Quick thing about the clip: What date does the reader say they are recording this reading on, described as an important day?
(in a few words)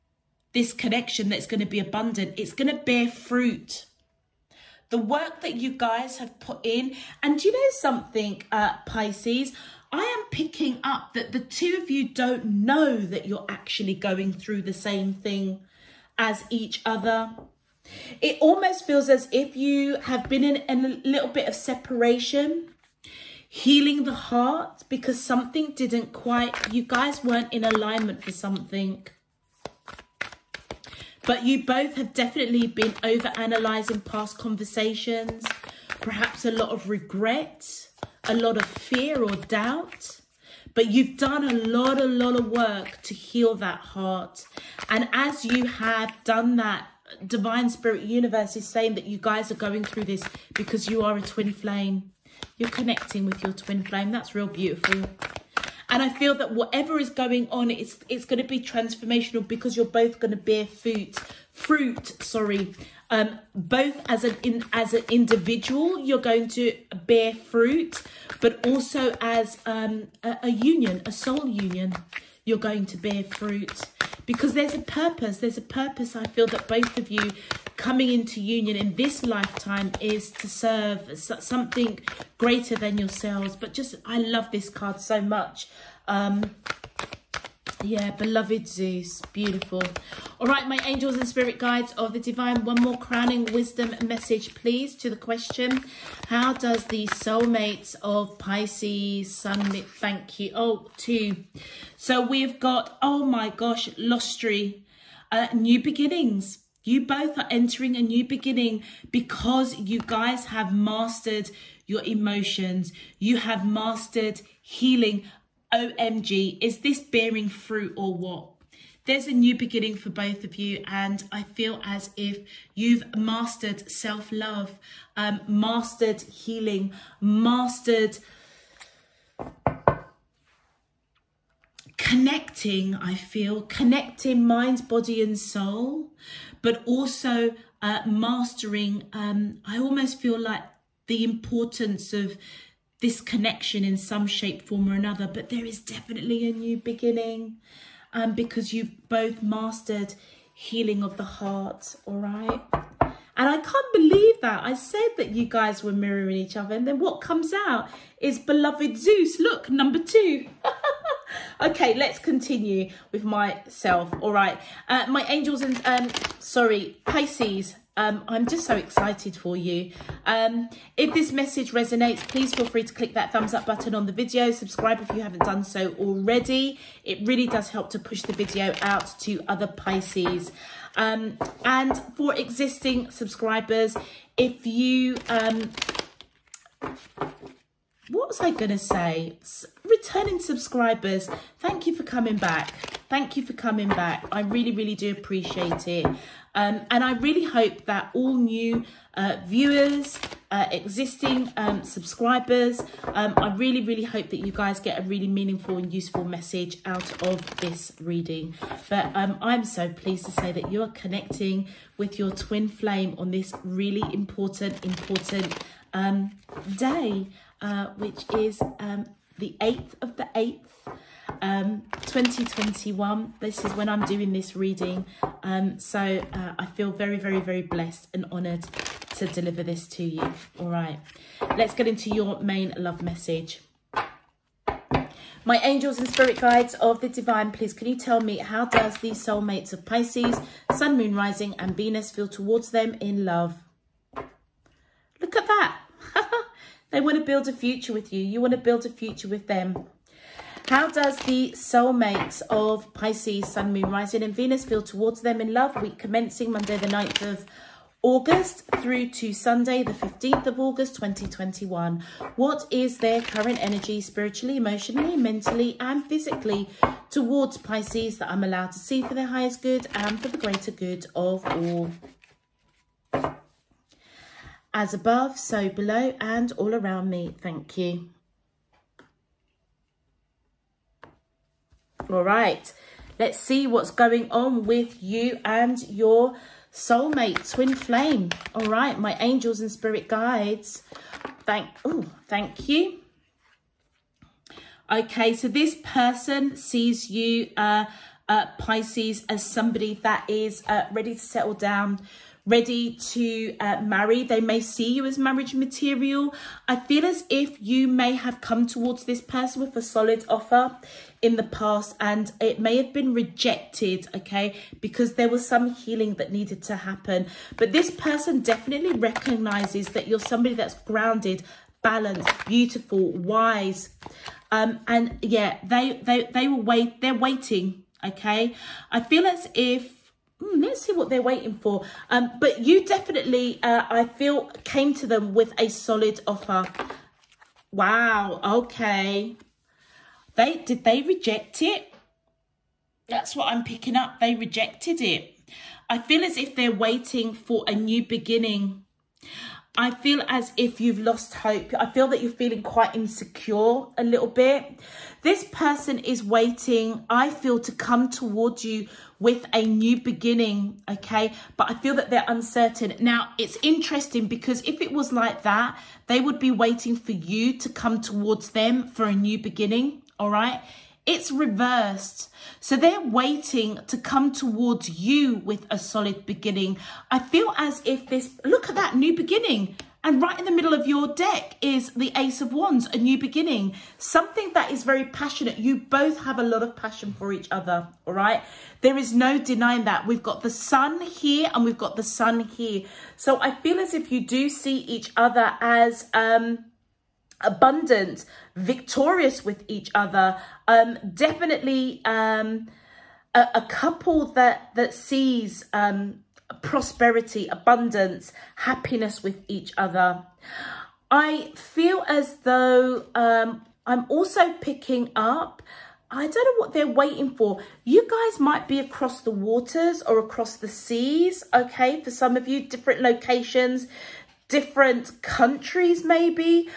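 8 August 2021.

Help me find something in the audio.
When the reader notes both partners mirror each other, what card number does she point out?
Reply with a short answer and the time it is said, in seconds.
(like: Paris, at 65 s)
2, at 159 s.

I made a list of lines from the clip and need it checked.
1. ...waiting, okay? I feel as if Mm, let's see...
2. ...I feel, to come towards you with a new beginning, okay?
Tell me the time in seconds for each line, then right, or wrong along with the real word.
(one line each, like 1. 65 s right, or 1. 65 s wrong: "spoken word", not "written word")
1. 327 s right
2. 357 s right.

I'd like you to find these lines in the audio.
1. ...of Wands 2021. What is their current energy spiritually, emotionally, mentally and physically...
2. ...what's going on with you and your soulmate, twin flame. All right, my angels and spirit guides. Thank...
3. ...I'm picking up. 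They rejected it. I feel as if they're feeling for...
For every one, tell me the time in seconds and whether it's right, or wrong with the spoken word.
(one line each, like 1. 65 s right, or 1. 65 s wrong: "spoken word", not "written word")
1. 260 s wrong: "August", not "Wands"
2. 283 s right
3. 343 s wrong: "waiting", not "feeling".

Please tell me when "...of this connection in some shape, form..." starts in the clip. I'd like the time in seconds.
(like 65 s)
142 s.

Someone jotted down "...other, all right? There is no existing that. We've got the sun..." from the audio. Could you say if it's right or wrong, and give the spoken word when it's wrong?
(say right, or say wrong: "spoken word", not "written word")
wrong: "denying", not "existing".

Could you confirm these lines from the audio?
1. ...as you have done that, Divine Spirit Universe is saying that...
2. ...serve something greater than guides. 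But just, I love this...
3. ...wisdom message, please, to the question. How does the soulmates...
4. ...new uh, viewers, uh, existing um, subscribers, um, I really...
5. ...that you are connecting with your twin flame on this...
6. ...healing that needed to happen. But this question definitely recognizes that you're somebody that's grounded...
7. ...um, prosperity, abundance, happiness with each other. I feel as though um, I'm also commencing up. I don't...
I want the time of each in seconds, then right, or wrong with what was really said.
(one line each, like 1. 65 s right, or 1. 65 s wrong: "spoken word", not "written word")
1. 45 s right
2. 80 s wrong: "yourselves", not "guides"
3. 93 s right
4. 198 s right
5. 210 s right
6. 315 s wrong: "person", not "question"
7. 405 s wrong: "picking", not "commencing".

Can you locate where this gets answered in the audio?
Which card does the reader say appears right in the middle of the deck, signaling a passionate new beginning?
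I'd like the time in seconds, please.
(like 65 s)
382 s.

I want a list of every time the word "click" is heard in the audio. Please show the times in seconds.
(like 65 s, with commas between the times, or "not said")
172 s.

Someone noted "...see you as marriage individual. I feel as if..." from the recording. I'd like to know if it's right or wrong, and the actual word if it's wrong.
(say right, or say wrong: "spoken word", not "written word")
wrong: "material", not "individual".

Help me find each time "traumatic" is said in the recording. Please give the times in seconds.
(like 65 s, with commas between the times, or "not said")
not said.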